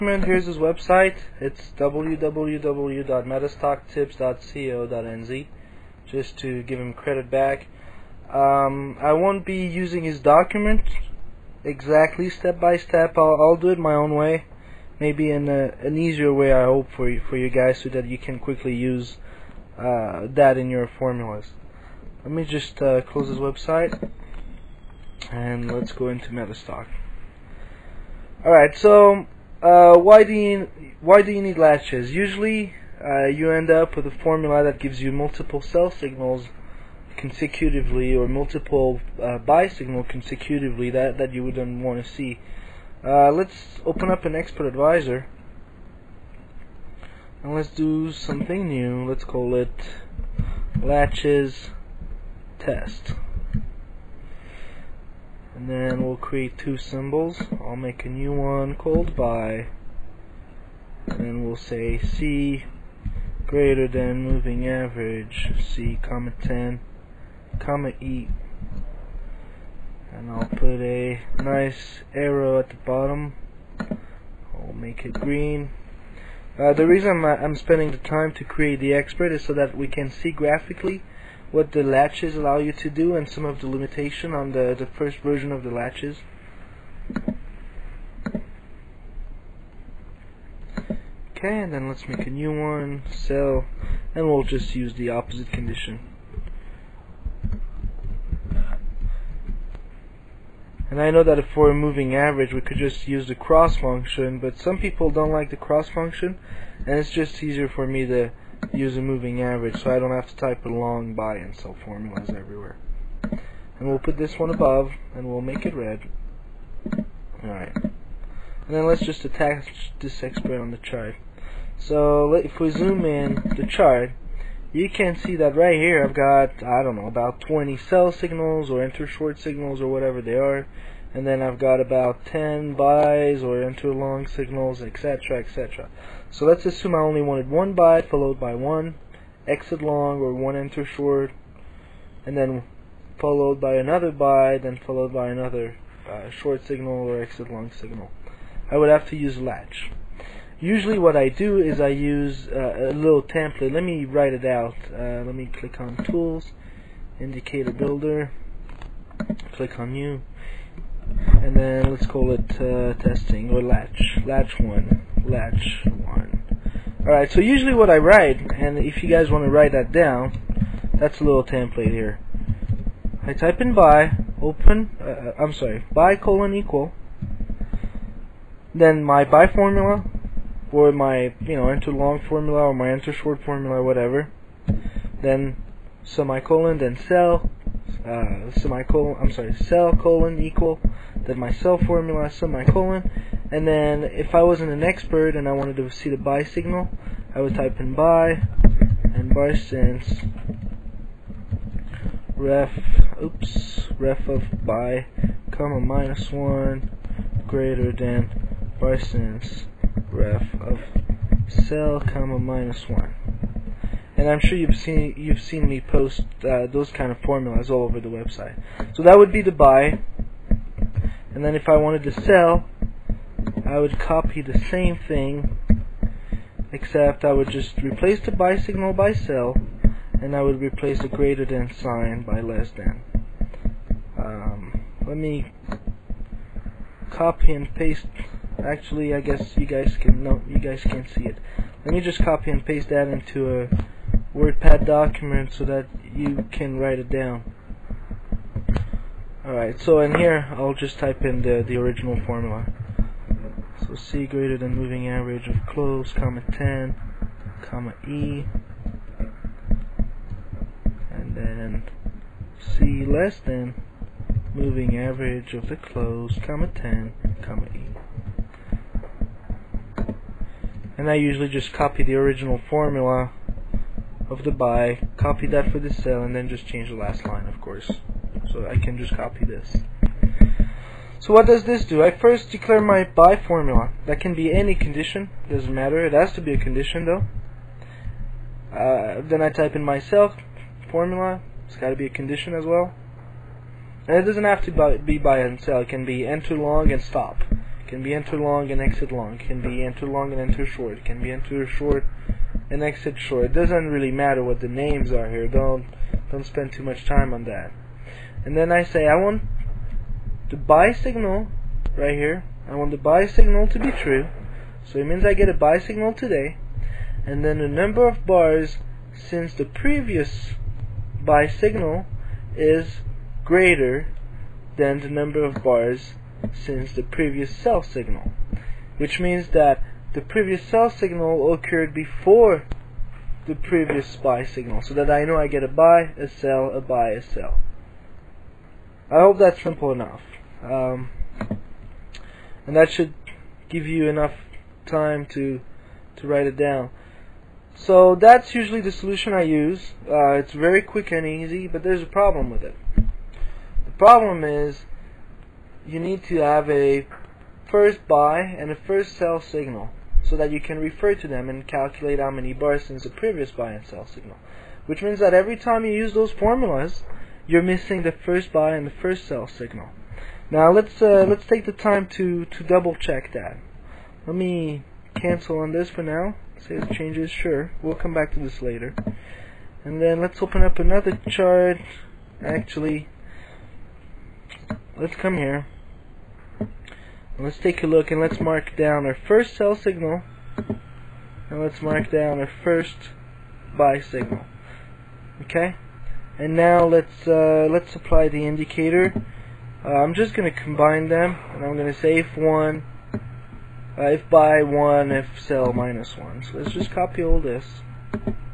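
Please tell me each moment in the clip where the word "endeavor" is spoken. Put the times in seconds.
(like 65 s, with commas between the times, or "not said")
not said.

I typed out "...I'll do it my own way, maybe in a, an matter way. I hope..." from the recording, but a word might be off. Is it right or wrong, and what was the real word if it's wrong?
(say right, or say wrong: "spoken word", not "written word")
wrong: "easier", not "matter".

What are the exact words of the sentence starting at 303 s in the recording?
It doesn't really matter what the names are here.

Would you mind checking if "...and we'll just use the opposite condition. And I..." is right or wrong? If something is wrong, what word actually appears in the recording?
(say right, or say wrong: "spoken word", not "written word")
right.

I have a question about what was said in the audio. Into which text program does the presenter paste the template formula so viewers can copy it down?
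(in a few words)
WordPad.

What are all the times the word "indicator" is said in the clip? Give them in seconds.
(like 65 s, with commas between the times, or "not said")
157 s, 398 s.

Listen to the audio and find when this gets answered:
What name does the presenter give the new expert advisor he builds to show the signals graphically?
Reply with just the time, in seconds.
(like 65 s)
50 s.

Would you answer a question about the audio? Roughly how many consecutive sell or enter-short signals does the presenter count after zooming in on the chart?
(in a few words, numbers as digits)
20.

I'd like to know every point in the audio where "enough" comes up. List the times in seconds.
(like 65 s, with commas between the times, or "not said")
339 s, 344 s.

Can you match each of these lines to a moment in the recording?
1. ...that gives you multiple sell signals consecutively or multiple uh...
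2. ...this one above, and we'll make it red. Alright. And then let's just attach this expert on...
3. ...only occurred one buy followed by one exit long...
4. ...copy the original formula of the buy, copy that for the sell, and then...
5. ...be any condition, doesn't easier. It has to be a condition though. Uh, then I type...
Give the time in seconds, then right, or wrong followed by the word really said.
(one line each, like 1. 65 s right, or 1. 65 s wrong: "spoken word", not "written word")
1. 34 s right
2. 114 s right
3. 136 s wrong: "wanted", not "occurred"
4. 271 s right
5. 284 s wrong: "matter", not "easier".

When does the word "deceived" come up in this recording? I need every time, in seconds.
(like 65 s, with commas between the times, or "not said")
not said.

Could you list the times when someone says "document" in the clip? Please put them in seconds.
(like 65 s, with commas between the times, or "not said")
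10 s, 244 s.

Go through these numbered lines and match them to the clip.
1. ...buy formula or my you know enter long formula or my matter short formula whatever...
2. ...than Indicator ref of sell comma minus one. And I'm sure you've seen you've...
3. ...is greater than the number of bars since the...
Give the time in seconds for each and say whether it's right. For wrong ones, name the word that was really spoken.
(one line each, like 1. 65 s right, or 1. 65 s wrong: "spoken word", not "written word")
1. 179 s wrong: "enter", not "matter"
2. 207 s wrong: "BarsSince", not "Indicator"
3. 322 s right.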